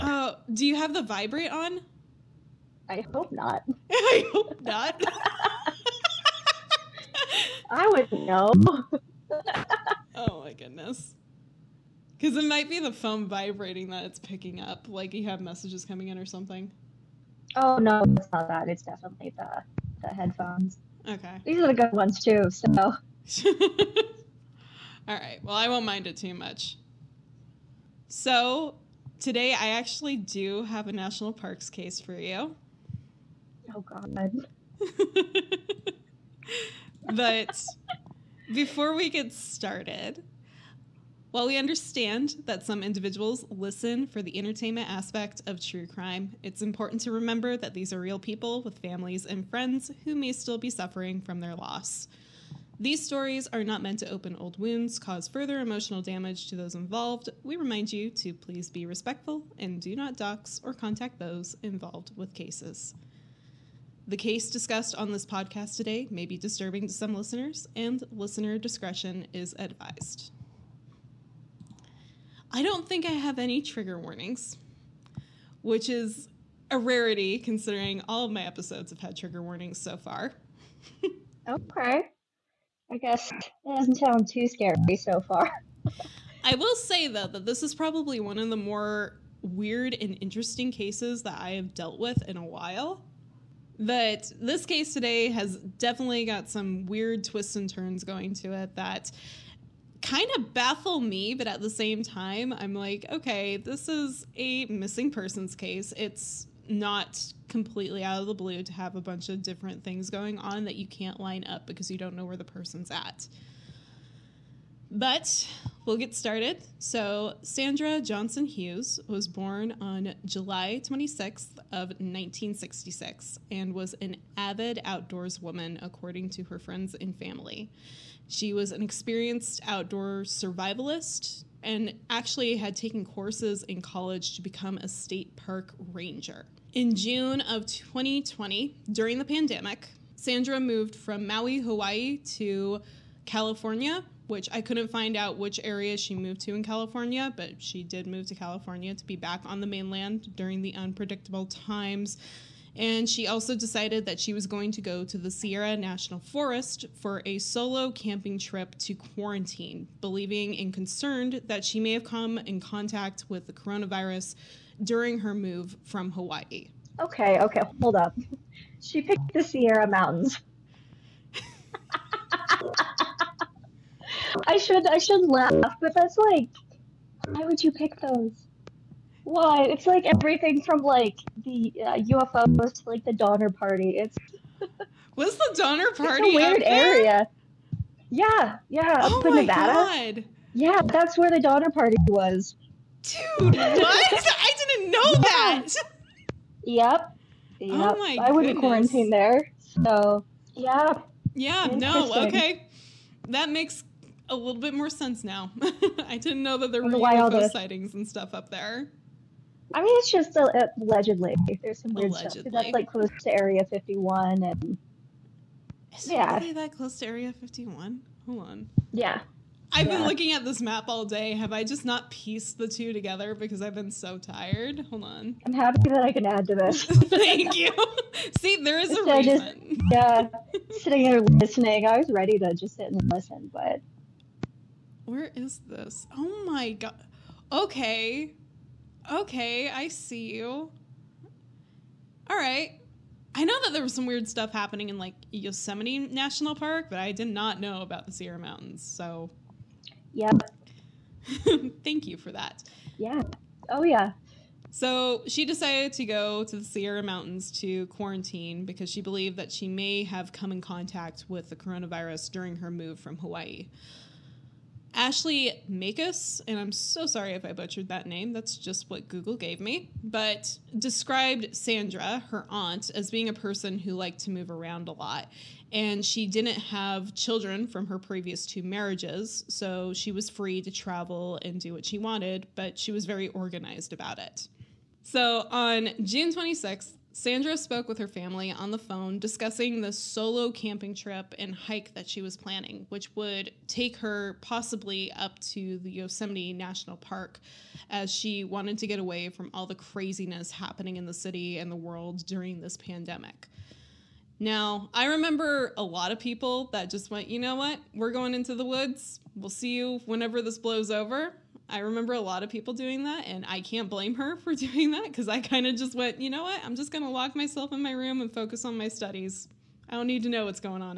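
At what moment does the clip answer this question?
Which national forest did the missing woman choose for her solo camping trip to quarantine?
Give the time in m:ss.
2:35.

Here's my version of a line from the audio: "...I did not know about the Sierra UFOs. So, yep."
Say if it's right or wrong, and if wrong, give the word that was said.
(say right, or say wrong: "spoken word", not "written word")
wrong: "Mountains", not "UFOs".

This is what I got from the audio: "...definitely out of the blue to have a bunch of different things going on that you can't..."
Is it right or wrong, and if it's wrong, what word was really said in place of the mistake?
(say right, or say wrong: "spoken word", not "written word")
wrong: "completely", not "definitely".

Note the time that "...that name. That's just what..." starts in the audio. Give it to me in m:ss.
4:27.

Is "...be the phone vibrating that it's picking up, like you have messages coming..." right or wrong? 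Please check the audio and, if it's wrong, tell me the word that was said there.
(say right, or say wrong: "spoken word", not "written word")
right.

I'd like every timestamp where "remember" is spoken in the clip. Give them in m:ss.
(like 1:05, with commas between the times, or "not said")
0:47, 5:05, 5:11.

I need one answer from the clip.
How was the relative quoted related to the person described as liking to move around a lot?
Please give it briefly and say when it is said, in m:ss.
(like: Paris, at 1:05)
aunt, at 4:32.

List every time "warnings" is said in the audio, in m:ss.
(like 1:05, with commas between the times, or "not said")
1:13, 1:19.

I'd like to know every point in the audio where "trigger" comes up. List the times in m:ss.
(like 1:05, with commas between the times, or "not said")
1:13, 1:19.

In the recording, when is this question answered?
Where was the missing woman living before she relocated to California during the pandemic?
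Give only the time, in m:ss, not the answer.
2:21.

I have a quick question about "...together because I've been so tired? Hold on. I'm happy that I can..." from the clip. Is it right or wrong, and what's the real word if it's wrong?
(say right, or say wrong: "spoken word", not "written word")
right.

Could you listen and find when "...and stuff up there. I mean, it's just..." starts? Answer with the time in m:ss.
3:27.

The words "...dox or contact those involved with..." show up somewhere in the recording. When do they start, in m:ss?
1:00.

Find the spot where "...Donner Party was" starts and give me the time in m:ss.
3:11.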